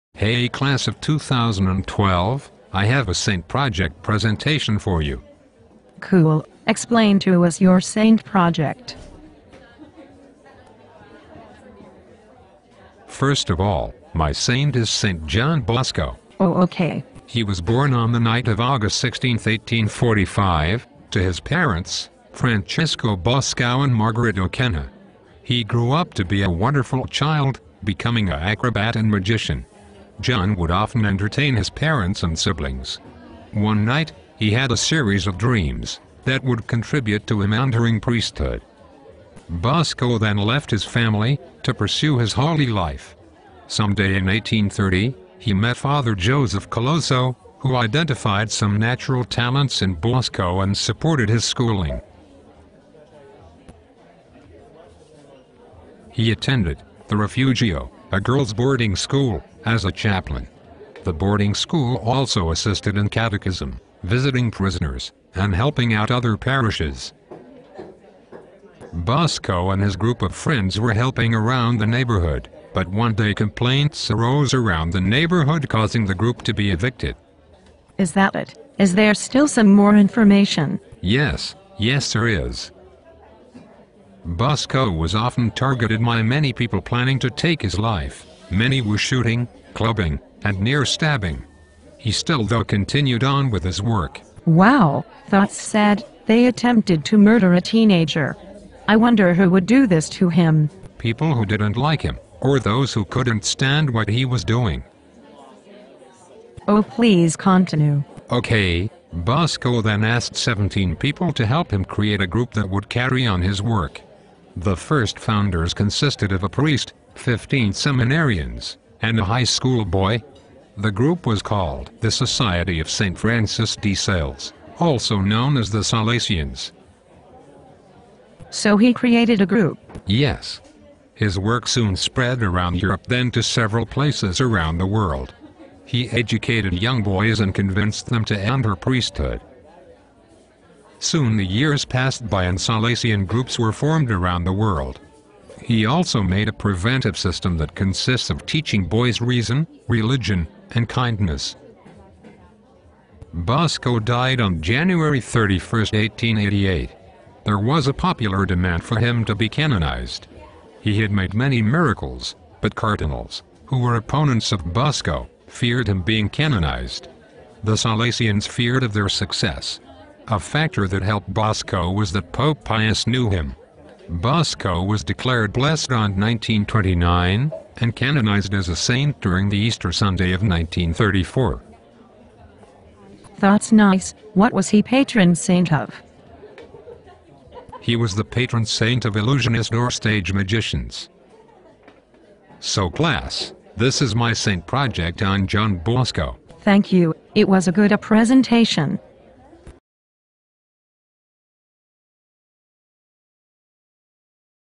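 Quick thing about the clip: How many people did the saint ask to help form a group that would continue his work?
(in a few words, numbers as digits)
17.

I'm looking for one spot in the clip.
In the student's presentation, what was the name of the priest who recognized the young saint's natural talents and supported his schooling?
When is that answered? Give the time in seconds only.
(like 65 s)
46 s.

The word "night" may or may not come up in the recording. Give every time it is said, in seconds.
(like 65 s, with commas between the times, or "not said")
18 s, 33 s.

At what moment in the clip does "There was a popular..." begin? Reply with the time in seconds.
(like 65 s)
157 s.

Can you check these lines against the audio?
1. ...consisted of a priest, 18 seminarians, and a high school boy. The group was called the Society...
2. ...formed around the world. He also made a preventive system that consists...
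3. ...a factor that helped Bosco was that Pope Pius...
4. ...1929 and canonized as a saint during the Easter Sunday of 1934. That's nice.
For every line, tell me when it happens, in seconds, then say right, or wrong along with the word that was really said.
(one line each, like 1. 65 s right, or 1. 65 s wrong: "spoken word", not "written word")
1. 115 s wrong: "15", not "18"
2. 143 s right
3. 170 s right
4. 176 s right.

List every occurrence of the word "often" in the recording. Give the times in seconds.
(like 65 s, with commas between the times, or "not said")
30 s, 85 s.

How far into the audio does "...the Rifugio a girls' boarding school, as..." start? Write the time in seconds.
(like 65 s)
57 s.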